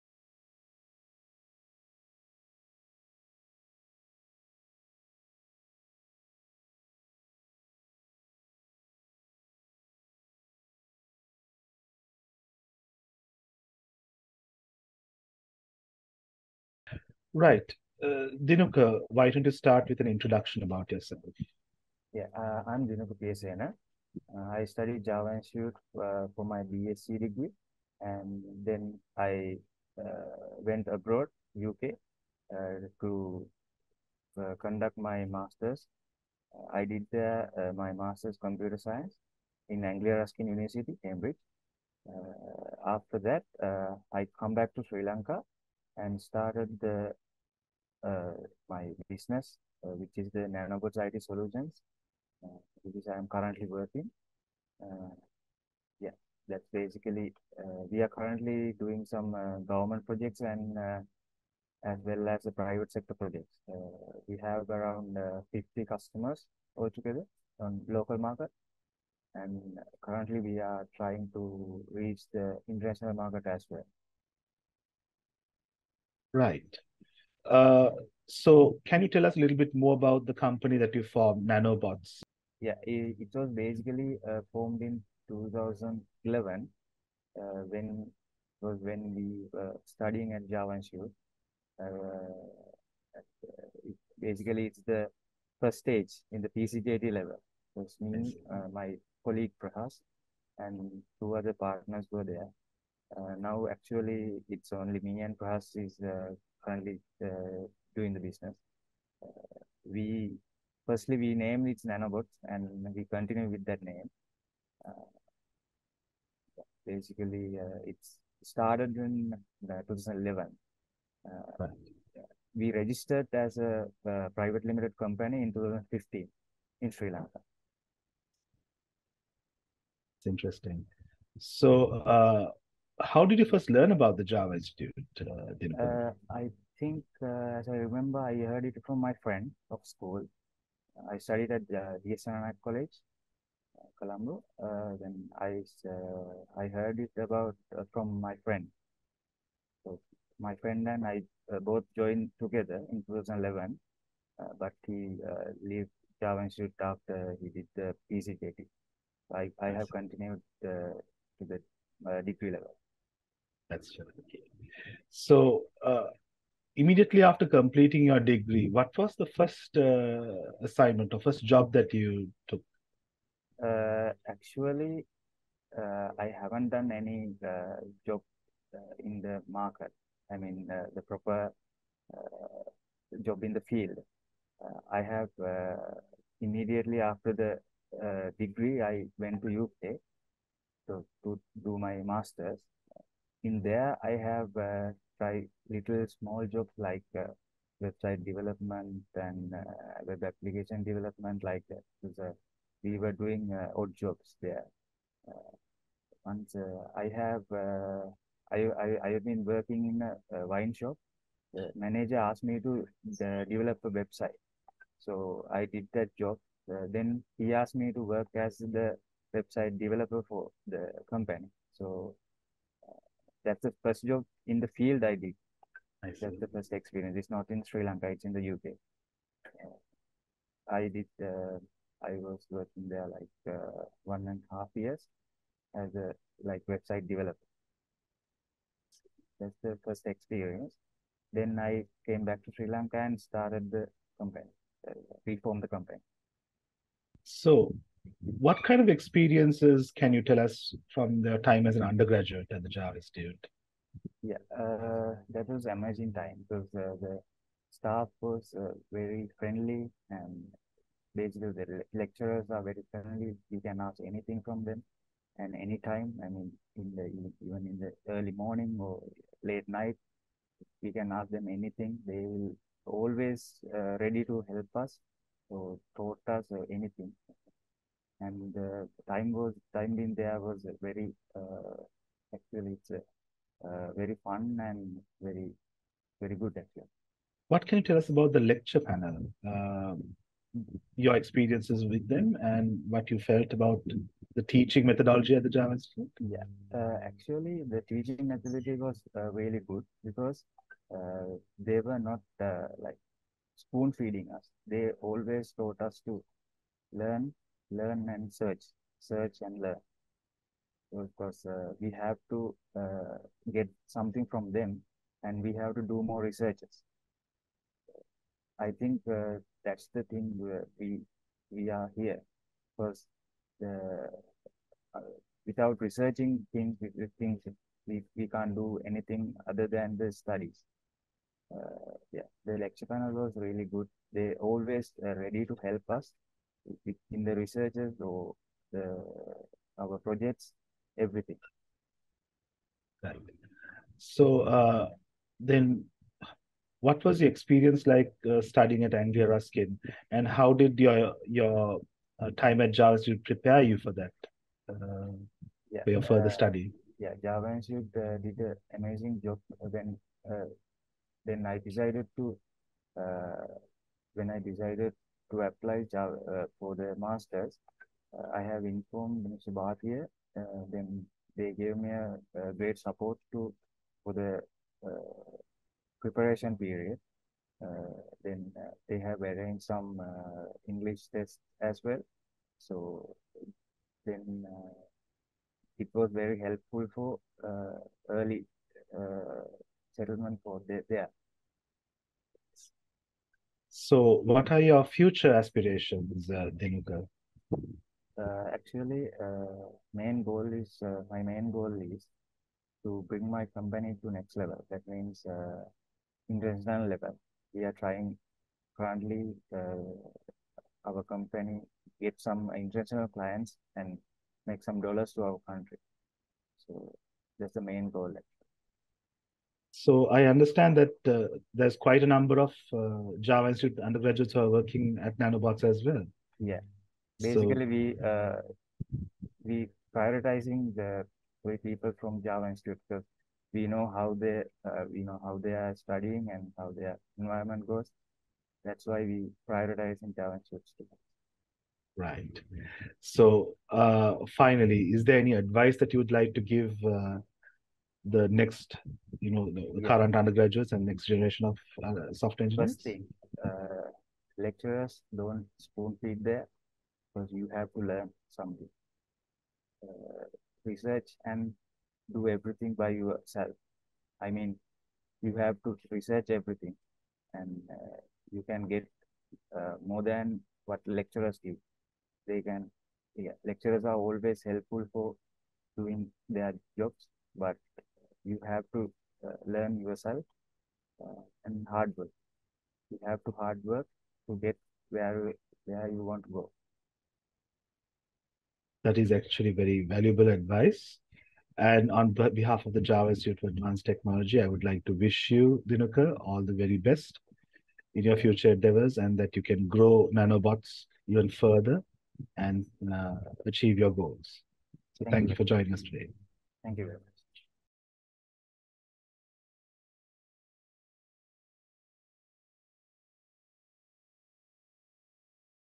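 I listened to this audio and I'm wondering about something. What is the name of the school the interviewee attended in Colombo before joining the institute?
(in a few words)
DSNR College.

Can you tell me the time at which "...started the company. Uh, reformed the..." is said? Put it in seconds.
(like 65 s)
243 s.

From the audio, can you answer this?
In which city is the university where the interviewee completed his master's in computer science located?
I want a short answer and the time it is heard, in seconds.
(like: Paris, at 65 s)
Cambridge, at 41 s.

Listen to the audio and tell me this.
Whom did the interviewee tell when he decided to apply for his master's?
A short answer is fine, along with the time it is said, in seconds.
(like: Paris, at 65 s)
Mr. Bhatia, at 369 s.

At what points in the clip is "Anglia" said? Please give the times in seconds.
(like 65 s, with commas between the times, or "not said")
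39 s, 348 s.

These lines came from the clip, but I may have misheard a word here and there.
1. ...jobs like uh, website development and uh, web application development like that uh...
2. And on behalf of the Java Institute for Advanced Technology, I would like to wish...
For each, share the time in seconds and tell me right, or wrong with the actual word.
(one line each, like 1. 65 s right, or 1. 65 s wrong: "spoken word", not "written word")
1. 196 s right
2. 491 s right.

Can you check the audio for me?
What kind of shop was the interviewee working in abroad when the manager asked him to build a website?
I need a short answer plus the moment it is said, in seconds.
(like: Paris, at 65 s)
A wine shop, at 210 s.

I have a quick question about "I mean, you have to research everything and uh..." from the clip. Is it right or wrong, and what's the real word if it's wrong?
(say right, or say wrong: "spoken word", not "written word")
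right.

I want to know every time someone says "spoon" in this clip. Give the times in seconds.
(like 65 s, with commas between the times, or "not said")
303 s, 455 s.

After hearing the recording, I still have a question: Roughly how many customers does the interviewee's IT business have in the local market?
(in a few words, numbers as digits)
50.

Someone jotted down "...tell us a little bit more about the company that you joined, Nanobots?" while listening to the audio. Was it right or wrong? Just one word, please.
wrong.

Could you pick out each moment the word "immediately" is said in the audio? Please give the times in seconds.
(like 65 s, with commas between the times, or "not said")
166 s, 186 s.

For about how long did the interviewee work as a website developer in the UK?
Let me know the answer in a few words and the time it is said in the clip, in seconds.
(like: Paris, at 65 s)
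1.5 years, at 234 s.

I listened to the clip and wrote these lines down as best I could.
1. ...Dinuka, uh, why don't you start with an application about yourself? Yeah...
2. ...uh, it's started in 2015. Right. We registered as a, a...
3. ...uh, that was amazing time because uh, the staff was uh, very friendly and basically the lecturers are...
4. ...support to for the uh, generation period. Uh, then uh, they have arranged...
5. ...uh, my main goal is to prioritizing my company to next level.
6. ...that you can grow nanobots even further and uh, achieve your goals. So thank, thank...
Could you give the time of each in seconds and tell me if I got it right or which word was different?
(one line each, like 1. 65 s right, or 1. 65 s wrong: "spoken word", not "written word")
1. 18 s wrong: "introduction", not "application"
2. 117 s wrong: "2011", not "2015"
3. 254 s right
4. 372 s wrong: "preparation", not "generation"
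5. 400 s wrong: "bring", not "prioritizing"
6. 499 s right.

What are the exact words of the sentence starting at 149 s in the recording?
So my friend and I both joined together in 2011, but he uh, left Java Institute after he did the PCJT.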